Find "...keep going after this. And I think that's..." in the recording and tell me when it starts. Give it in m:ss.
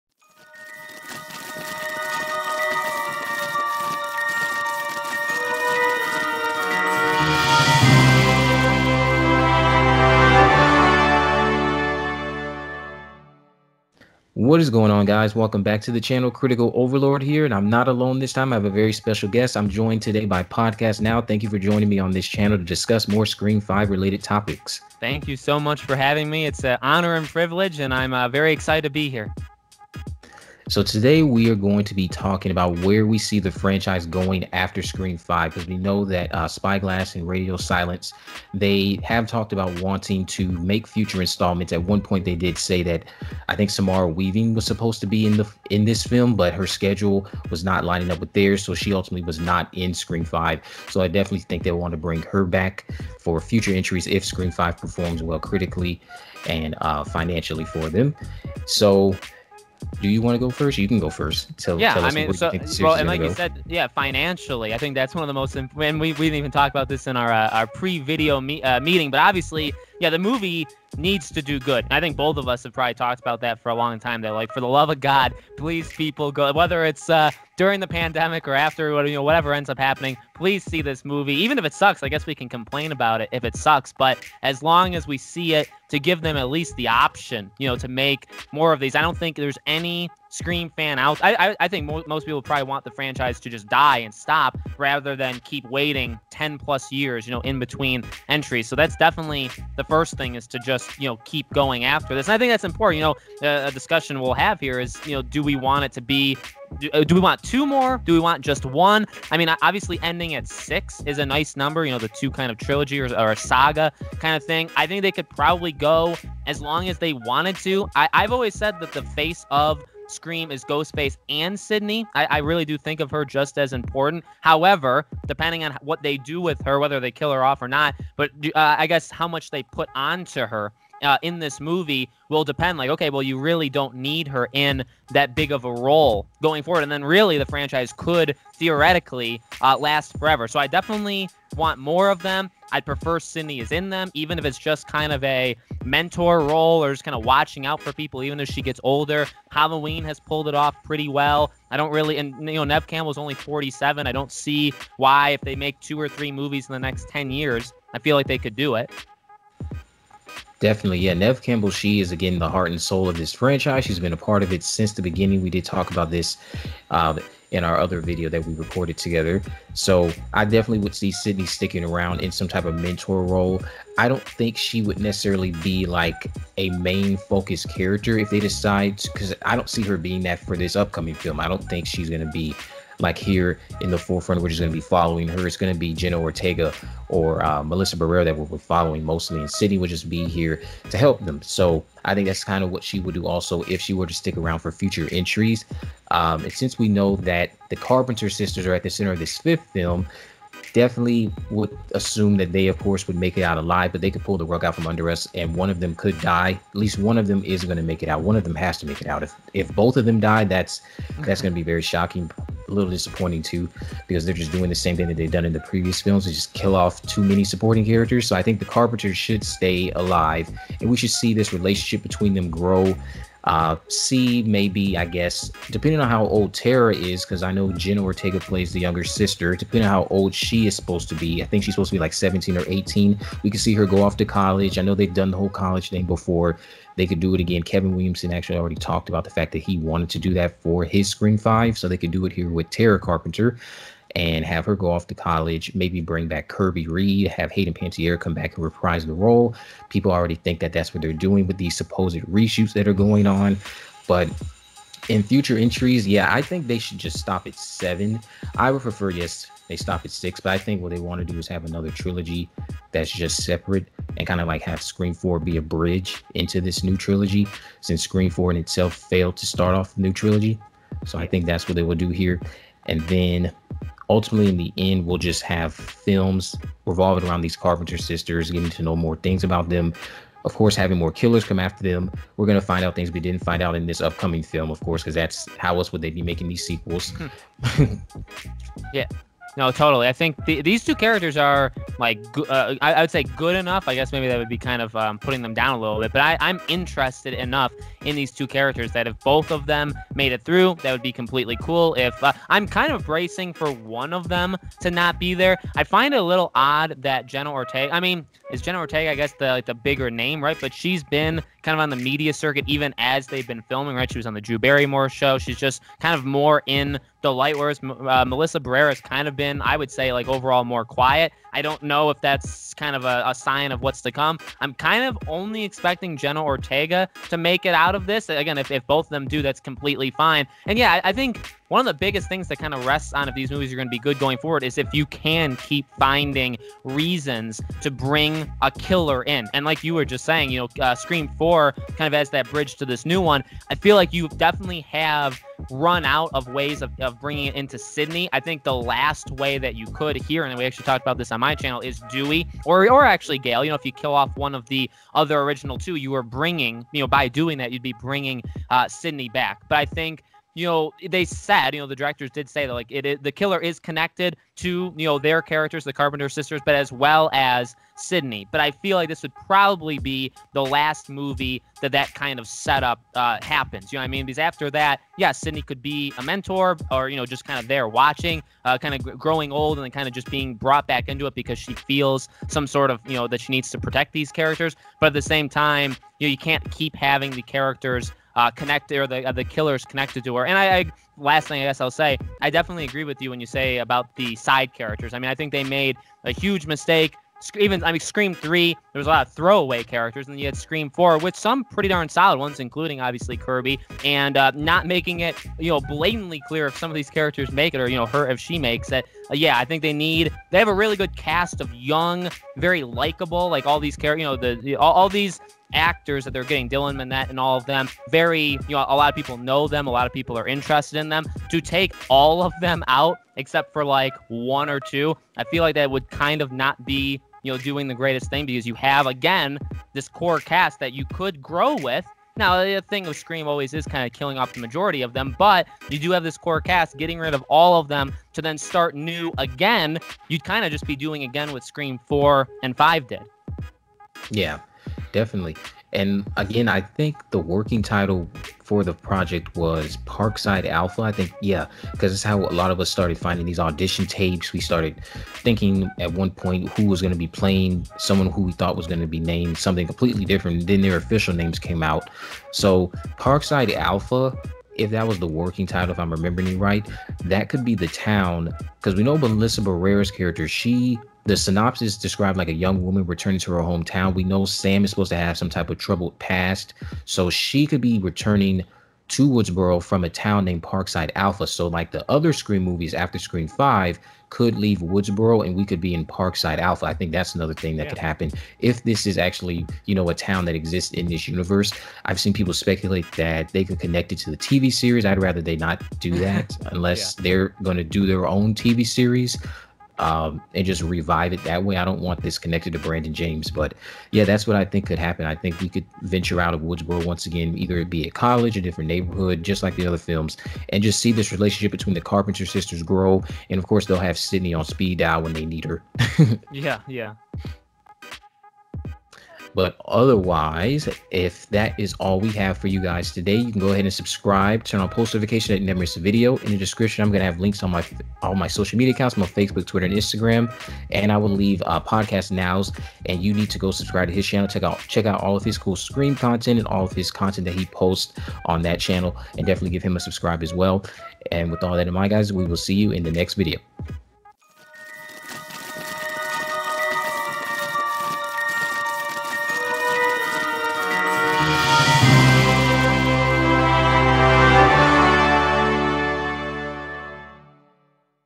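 1:41.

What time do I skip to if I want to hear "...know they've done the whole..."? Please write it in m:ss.
3:54.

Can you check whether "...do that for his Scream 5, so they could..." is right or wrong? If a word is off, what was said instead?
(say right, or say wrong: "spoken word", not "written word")
right.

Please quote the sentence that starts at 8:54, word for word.
Check out check out all of his cool scream content and all of his content that he posts on that channel.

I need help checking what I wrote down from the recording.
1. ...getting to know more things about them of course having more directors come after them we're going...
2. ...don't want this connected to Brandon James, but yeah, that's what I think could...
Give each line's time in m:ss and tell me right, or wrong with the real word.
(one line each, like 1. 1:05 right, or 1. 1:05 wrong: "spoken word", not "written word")
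1. 4:38 wrong: "killers", not "directors"
2. 8:21 right.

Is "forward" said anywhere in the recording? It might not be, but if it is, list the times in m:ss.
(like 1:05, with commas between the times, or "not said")
2:16, 5:34.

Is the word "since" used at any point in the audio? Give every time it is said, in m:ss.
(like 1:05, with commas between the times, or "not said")
2:44, 3:16, 4:27.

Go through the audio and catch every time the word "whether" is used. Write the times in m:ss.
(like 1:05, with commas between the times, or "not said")
1:16, 2:06.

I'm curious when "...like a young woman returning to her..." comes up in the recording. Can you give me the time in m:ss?
7:52.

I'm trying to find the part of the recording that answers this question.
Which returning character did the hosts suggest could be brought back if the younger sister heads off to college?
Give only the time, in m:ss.
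4:06.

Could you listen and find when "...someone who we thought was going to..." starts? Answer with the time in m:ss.
7:37.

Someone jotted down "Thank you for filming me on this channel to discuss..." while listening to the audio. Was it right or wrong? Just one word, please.
wrong.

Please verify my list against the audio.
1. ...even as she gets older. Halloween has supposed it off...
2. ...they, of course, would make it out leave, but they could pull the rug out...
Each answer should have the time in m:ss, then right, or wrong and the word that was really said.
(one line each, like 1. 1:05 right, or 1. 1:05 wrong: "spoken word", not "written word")
1. 2:28 wrong: "pulled", not "supposed"
2. 3:22 wrong: "alive", not "leave".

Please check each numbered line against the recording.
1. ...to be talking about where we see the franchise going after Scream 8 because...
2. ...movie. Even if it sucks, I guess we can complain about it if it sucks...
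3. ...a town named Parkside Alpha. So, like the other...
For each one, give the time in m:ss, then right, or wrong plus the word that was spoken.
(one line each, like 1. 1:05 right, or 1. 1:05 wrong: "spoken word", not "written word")
1. 0:31 wrong: "5", not "8"
2. 1:21 right
3. 8:00 right.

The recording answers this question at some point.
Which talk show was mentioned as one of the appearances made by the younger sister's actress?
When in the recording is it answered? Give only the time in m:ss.
5:14.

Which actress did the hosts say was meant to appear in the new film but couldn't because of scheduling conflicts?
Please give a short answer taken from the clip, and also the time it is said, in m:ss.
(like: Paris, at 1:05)
Samara Weaving, at 0:43.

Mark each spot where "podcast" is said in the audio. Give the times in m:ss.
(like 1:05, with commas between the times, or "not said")
0:20, 8:51.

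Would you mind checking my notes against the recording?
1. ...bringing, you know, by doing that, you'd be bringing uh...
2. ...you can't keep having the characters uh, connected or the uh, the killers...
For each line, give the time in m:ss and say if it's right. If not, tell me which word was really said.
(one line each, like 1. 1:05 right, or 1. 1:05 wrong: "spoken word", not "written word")
1. 5:56 right
2. 6:26 right.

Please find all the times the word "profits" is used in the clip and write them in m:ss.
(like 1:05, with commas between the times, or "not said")
not said.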